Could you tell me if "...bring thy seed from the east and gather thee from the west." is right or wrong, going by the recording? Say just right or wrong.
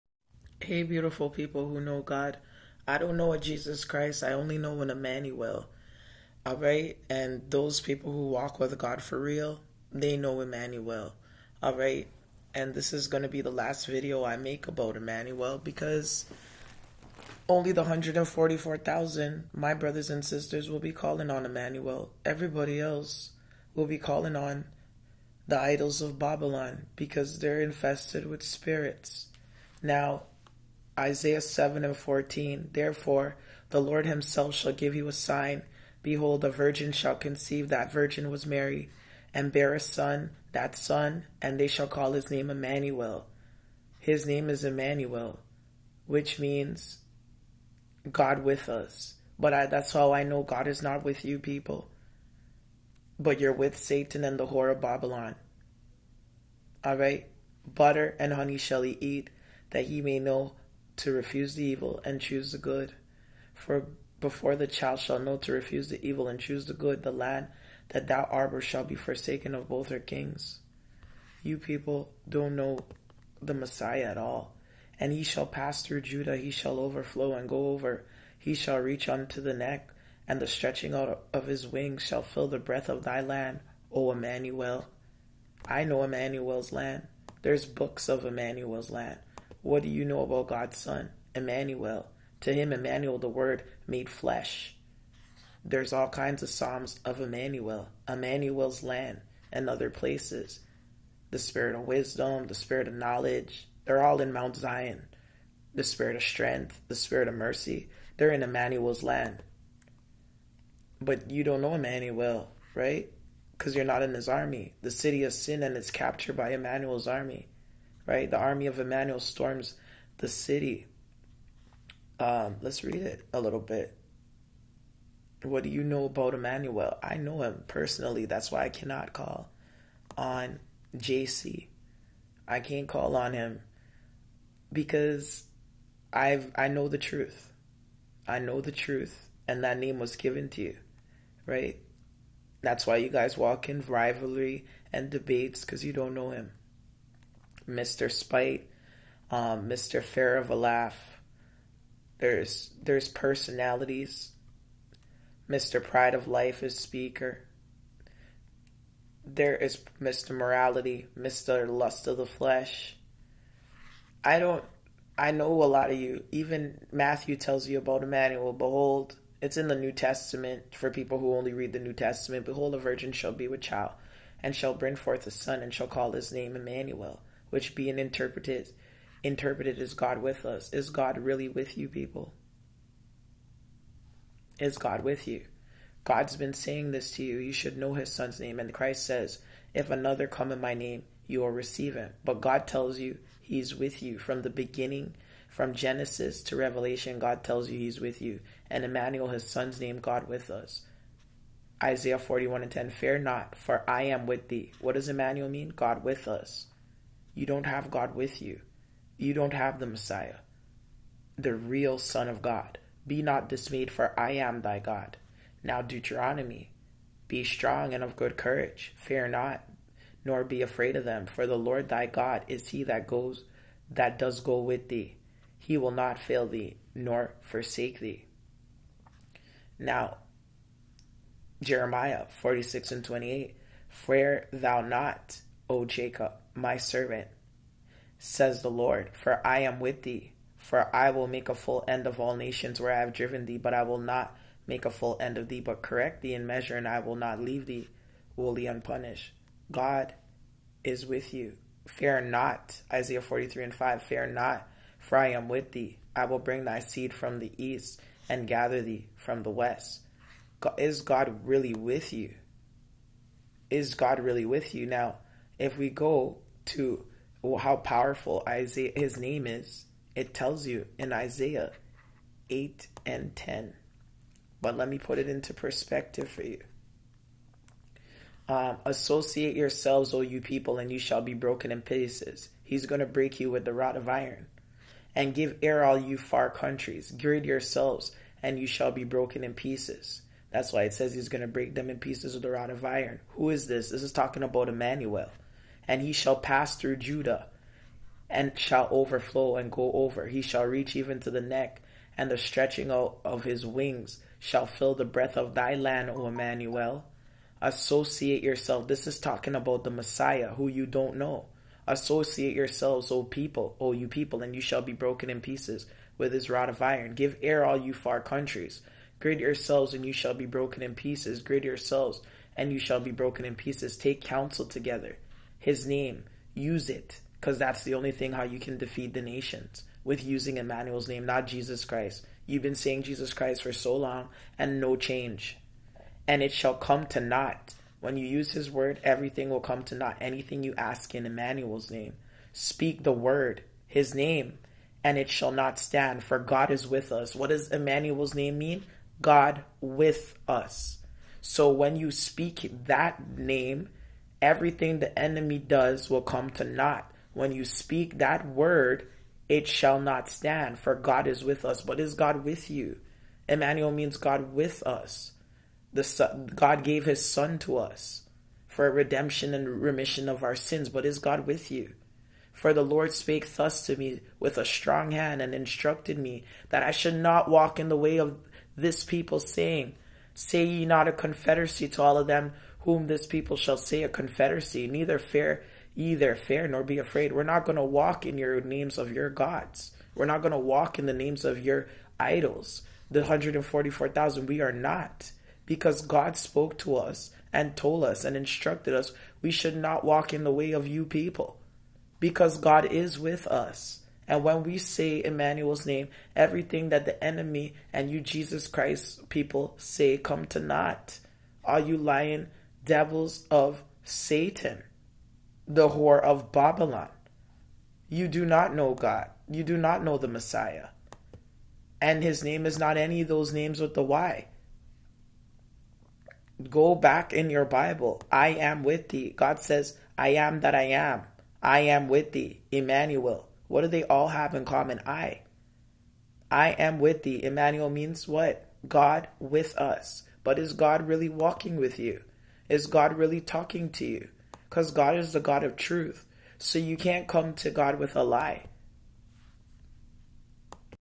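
right.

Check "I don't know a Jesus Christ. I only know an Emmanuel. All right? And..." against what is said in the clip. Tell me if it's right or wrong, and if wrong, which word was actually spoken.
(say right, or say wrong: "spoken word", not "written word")
right.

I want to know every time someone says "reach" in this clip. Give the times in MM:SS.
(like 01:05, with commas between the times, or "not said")
01:18, 05:00.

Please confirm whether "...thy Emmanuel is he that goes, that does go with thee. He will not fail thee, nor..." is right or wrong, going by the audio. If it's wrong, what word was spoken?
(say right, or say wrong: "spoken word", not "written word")
wrong: "God", not "Emmanuel".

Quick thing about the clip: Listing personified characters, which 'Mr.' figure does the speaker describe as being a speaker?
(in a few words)
Mr. Pride of Life.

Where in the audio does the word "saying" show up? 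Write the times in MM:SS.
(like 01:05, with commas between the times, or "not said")
03:06, 05:32, 06:19.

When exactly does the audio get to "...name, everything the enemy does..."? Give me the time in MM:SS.
05:53.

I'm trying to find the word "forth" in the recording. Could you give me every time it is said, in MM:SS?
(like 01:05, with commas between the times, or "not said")
02:54.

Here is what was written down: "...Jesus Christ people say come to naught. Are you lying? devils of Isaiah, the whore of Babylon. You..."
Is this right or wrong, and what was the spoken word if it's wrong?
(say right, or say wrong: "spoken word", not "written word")
wrong: "Satan", not "Isaiah".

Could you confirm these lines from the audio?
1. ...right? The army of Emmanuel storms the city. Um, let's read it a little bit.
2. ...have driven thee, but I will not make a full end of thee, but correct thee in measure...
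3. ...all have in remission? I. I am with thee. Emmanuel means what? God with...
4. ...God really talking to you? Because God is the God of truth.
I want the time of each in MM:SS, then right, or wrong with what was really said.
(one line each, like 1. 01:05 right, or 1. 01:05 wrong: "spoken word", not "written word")
1. 01:58 right
2. 04:02 right
3. 07:14 wrong: "common", not "remission"
4. 07:22 right.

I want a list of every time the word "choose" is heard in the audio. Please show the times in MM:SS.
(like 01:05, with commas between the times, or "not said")
01:02, 01:06.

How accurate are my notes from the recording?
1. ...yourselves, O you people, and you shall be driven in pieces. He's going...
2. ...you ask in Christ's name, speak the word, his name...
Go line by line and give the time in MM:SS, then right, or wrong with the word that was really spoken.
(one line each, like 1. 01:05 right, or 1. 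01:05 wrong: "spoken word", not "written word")
1. 04:39 wrong: "broken", not "driven"
2. 05:40 wrong: "Emmanuel", not "Christ".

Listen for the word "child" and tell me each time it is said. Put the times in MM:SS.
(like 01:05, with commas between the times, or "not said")
01:04, 02:53.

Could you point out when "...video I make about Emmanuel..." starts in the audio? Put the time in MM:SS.
00:13.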